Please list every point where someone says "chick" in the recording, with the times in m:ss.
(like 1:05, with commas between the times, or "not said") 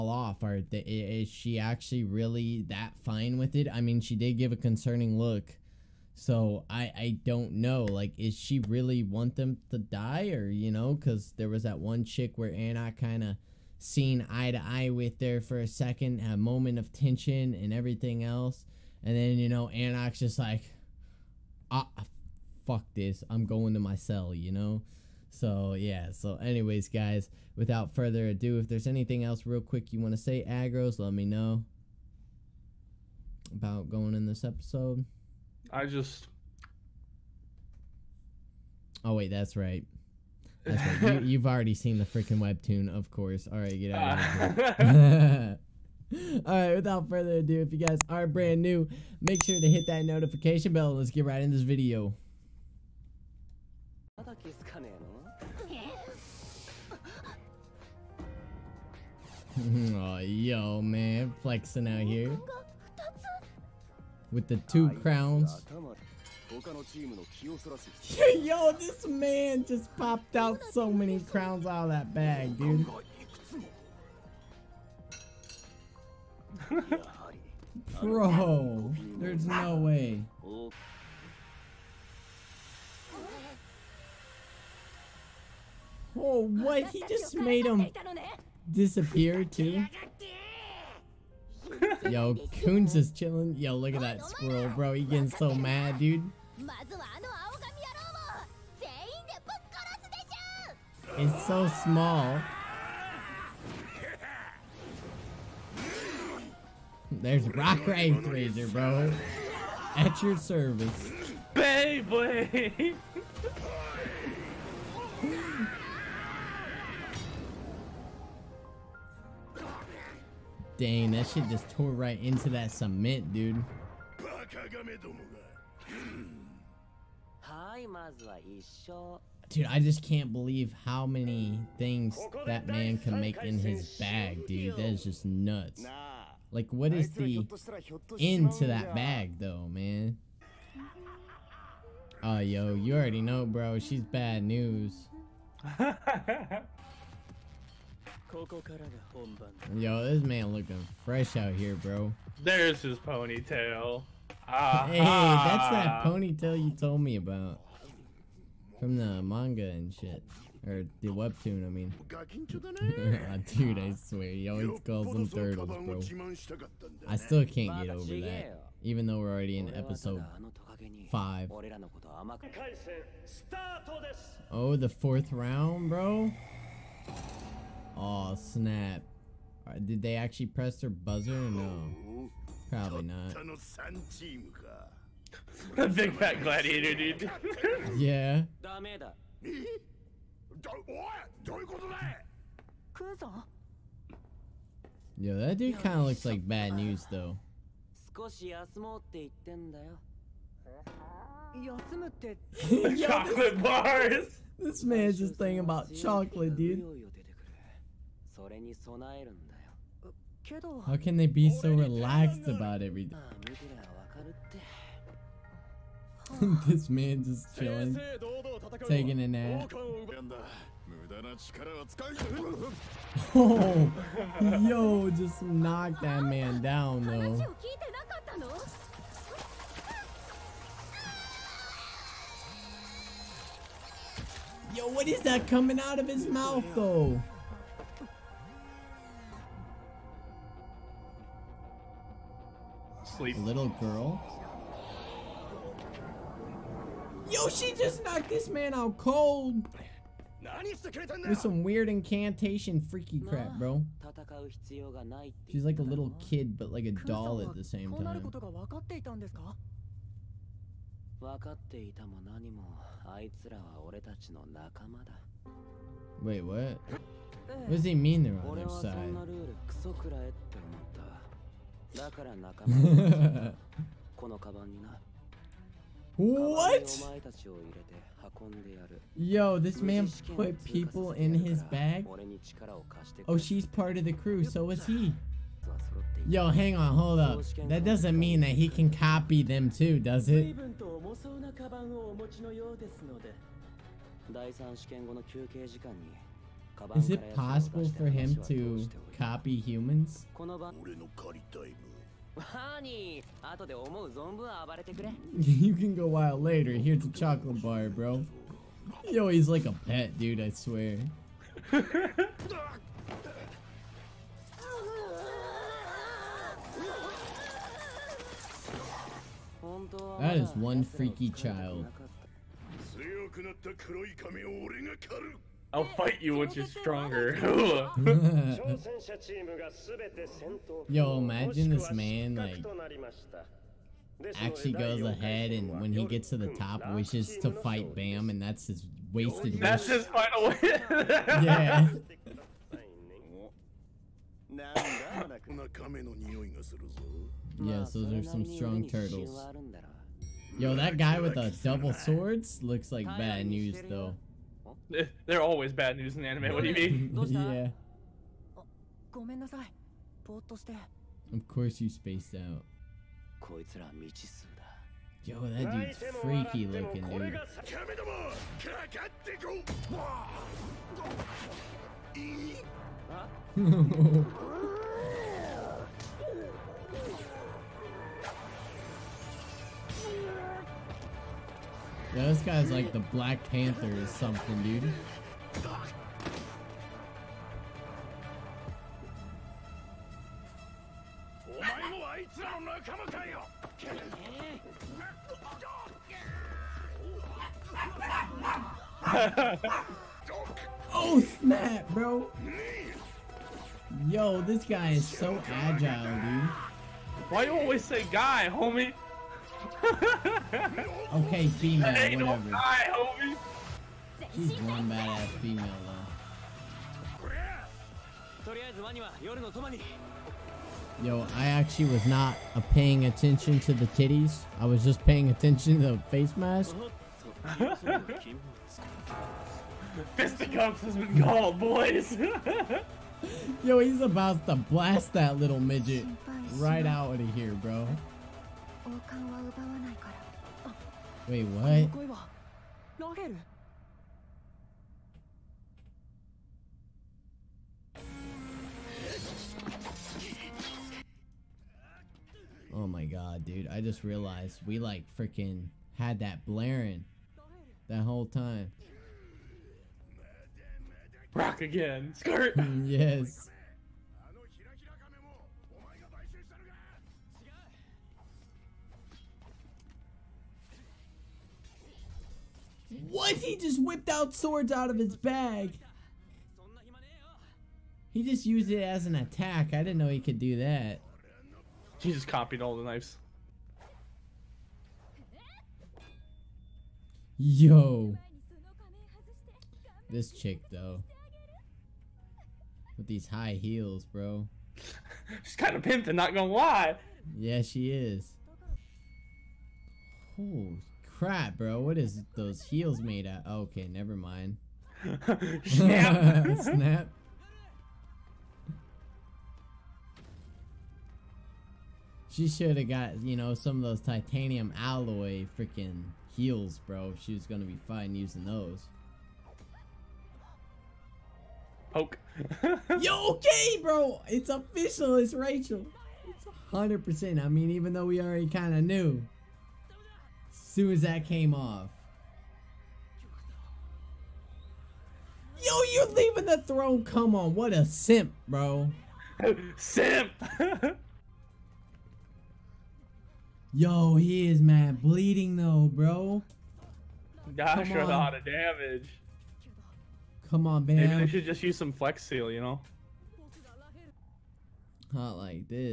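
0:12, 8:10.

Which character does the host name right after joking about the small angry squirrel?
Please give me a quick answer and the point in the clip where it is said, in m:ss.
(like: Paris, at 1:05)
Rak Wraithraiser, at 1:47.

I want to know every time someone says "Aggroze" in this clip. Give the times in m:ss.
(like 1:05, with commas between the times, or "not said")
0:30.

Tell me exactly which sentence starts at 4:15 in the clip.
She's like a little kid, but like a doll at the same time.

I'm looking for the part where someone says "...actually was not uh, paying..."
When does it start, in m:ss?
7:01.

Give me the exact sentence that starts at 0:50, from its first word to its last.
Let's get right in this video.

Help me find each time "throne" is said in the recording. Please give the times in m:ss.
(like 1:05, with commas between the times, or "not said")
8:56.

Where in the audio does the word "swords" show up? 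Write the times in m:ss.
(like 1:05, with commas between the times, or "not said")
5:51, 7:54.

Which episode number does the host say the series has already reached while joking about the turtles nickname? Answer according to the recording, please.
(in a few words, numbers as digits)
5.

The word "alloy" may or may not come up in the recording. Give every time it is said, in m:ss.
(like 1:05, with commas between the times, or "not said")
8:34.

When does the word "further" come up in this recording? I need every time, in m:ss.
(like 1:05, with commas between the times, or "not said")
0:27, 0:47.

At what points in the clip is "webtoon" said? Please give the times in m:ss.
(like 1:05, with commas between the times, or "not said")
0:42, 2:41.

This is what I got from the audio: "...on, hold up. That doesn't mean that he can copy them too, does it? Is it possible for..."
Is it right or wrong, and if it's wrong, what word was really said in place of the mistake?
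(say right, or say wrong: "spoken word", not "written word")
right.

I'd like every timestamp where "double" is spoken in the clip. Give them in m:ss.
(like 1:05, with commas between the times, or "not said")
5:51.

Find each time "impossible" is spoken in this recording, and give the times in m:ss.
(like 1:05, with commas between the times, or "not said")
not said.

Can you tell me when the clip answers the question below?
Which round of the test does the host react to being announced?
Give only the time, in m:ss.
2:54.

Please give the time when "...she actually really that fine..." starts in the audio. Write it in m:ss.
0:01.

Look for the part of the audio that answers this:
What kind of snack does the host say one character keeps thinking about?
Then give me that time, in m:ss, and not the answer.
3:22.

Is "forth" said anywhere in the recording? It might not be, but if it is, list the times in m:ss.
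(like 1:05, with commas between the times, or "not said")
not said.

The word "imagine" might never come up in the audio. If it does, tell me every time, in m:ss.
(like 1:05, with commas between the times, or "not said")
5:31.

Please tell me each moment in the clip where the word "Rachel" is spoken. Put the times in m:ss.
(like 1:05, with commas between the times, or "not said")
8:45.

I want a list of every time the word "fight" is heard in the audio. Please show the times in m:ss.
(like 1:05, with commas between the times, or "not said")
5:25, 5:37.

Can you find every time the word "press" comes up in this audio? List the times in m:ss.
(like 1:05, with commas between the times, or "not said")
3:00.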